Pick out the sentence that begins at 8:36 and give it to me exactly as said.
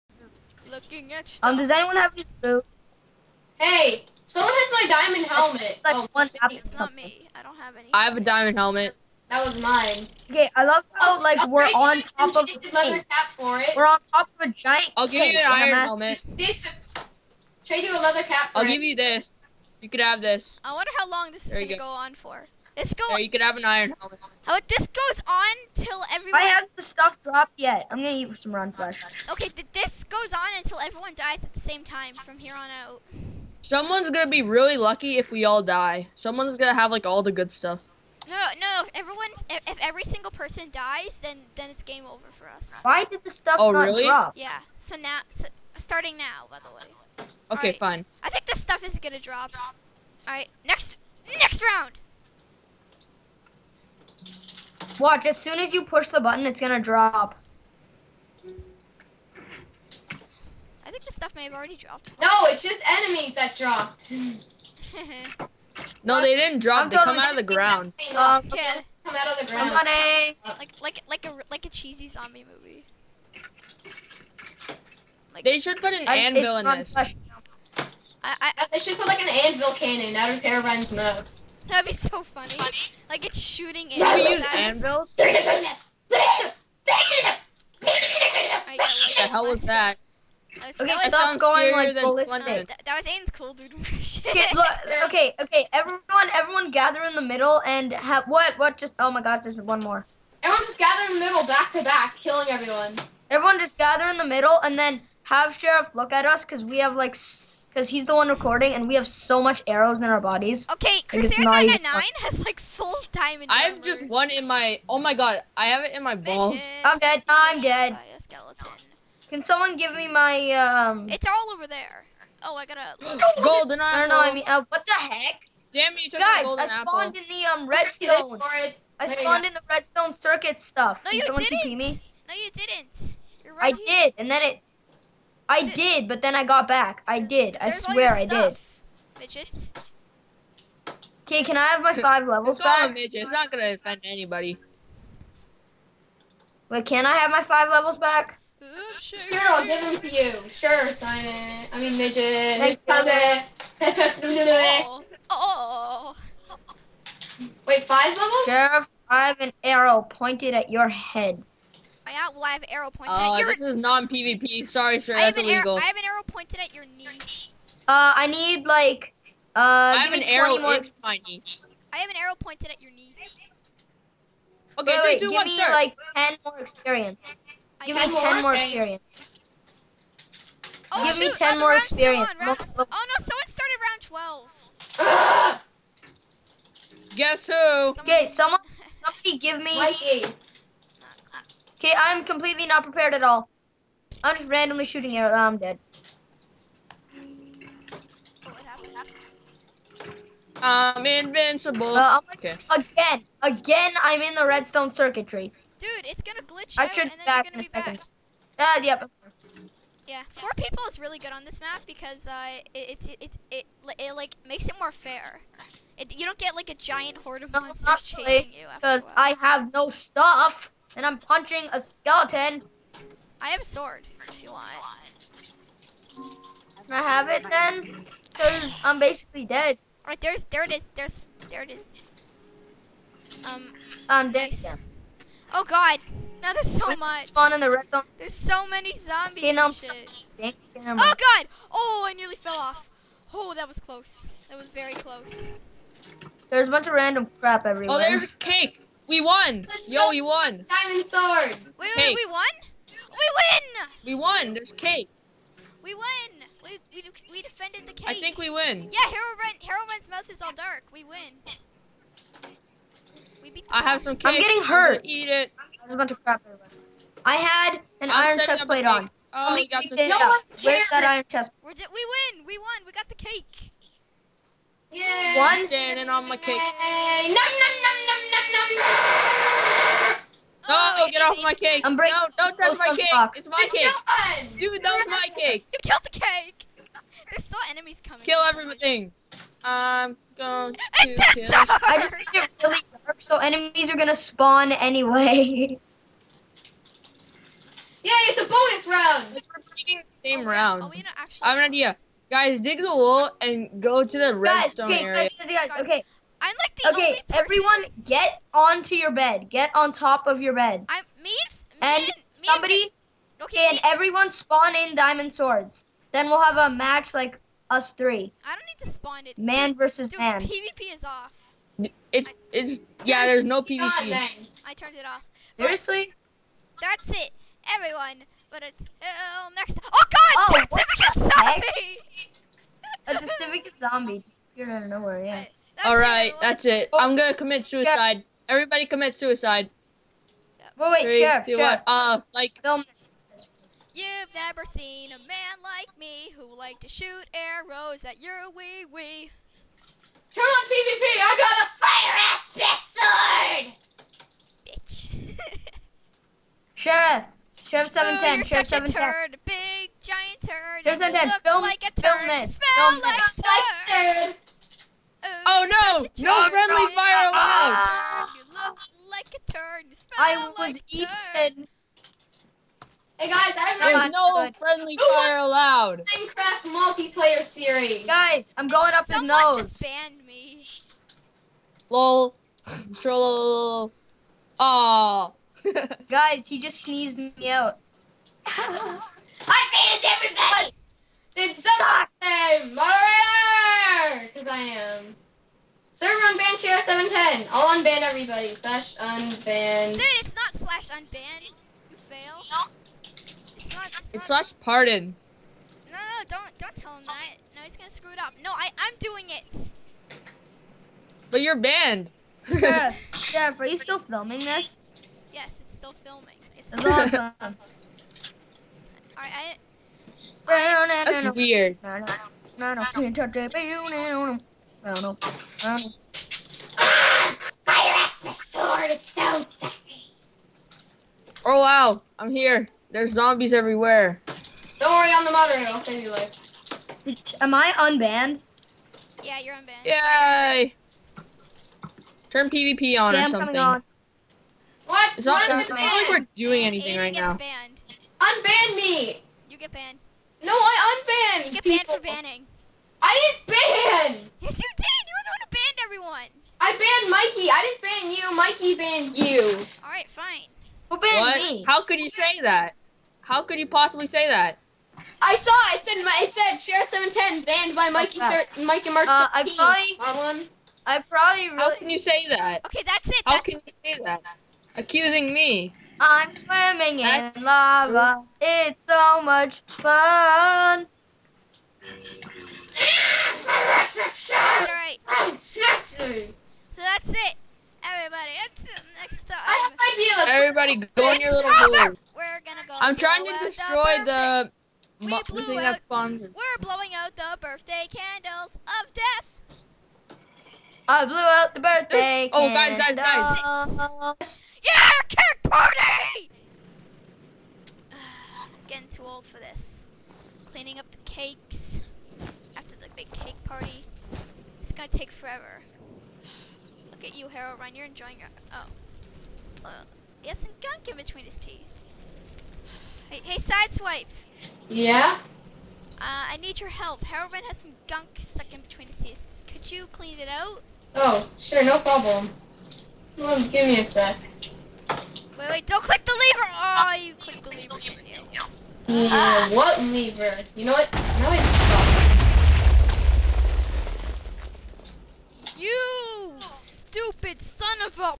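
Look at you, Herobrine, you're enjoying your- oh.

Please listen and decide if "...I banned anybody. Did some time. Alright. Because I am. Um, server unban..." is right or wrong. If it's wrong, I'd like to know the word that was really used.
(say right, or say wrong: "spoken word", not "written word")
wrong: "everybody", not "anybody".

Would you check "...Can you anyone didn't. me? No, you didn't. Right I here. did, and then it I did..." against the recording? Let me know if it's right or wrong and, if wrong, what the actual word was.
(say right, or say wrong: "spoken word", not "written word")
wrong: "someone", not "anyone".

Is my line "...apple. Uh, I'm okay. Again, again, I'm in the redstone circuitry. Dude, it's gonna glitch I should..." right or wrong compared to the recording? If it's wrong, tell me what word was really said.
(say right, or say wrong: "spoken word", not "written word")
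wrong: "invincible", not "apple".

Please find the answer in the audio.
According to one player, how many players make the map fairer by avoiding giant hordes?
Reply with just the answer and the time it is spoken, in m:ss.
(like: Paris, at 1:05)
4, at 3:30.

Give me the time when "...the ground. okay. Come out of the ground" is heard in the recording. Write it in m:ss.
1:07.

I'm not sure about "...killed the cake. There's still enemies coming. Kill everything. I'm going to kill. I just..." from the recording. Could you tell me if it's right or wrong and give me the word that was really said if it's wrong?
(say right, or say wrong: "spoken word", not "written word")
right.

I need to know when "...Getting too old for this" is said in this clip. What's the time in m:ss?
8:28.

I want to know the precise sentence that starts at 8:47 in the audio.
Herobrine has some gunk stuck in between his teeth.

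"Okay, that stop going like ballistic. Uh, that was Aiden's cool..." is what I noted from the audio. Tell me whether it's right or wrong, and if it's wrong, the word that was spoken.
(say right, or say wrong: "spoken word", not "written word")
right.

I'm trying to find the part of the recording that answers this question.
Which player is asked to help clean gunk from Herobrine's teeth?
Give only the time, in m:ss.
8:43.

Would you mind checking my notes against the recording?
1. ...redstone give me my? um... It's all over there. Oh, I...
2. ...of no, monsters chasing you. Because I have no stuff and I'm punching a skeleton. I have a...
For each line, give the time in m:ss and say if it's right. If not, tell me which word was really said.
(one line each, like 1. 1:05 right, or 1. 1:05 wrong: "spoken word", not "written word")
1. 1:59 wrong: "someone", not "redstone"
2. 3:37 right.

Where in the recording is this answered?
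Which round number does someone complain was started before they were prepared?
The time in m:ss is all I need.
3:03.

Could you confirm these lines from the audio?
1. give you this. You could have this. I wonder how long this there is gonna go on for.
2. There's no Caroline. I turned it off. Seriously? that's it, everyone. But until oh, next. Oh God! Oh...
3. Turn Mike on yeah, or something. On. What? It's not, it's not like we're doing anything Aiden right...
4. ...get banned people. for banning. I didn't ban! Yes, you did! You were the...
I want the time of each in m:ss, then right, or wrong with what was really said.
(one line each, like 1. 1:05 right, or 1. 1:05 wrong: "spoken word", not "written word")
1. 0:18 right
2. 5:23 wrong: "PvP", not "Caroline"
3. 7:22 wrong: "PvP", not "Mike"
4. 7:31 right.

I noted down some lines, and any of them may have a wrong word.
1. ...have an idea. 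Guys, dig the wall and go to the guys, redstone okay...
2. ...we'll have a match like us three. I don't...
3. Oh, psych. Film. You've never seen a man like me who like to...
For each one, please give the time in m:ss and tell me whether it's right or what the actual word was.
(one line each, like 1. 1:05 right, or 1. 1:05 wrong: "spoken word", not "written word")
1. 5:01 right
2. 5:16 right
3. 5:41 right.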